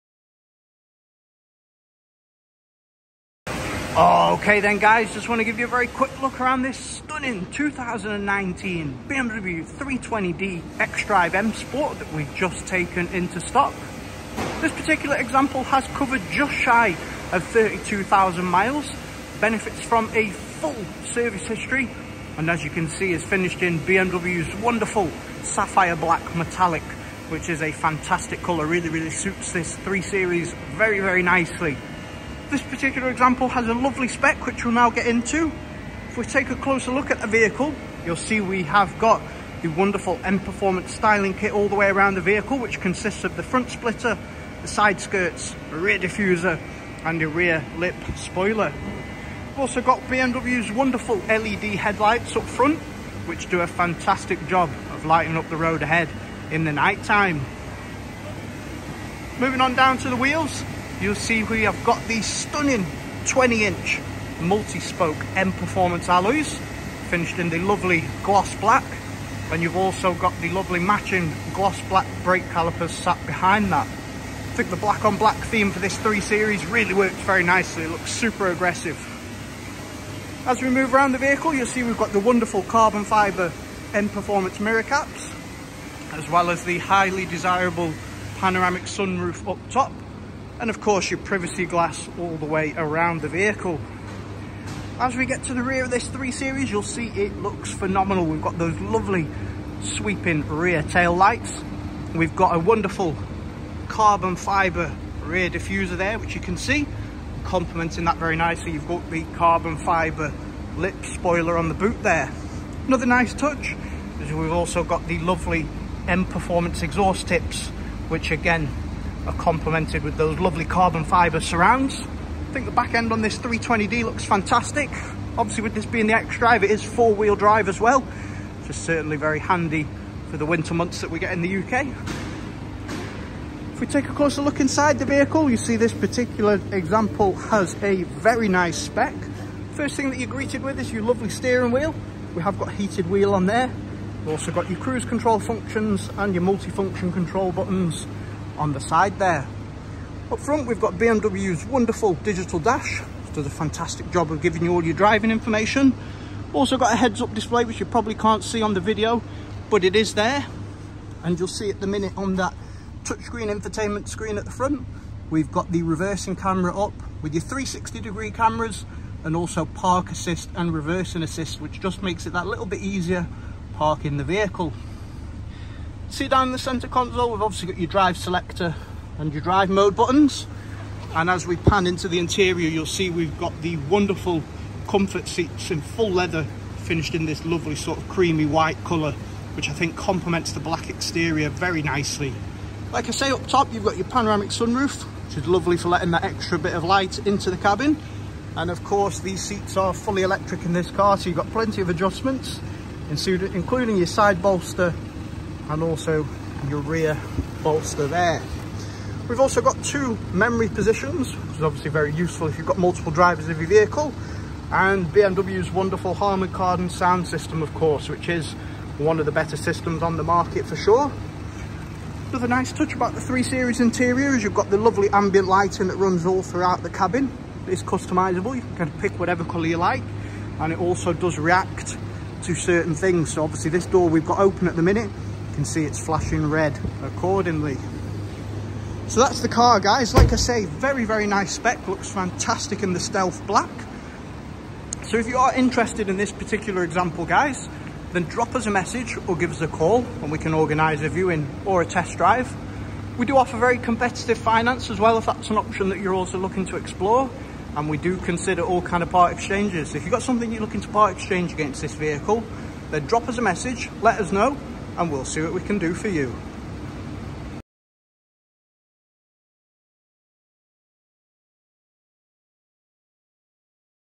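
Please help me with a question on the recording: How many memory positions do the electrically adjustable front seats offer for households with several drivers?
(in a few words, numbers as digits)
2.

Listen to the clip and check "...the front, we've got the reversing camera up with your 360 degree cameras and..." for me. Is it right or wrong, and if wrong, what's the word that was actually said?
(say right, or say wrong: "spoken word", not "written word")
right.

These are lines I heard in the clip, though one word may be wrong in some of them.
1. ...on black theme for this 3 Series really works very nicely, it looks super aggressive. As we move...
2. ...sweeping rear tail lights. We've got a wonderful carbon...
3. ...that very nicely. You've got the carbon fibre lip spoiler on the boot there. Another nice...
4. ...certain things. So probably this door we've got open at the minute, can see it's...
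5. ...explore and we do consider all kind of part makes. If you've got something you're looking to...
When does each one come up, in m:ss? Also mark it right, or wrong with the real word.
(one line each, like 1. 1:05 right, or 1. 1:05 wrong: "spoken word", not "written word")
1. 1:15 right
2. 1:39 right
3. 1:48 right
4. 3:52 wrong: "obviously", not "probably"
5. 4:16 wrong: "exchanges", not "makes".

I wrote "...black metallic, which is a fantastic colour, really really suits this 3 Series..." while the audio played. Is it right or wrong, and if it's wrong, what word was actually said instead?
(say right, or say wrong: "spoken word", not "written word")
right.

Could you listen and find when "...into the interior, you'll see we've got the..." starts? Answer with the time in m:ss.
3:01.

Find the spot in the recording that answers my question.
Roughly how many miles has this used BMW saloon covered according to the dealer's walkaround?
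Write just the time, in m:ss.
0:17.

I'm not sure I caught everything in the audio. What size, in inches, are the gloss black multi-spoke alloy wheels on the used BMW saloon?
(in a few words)
20 inch.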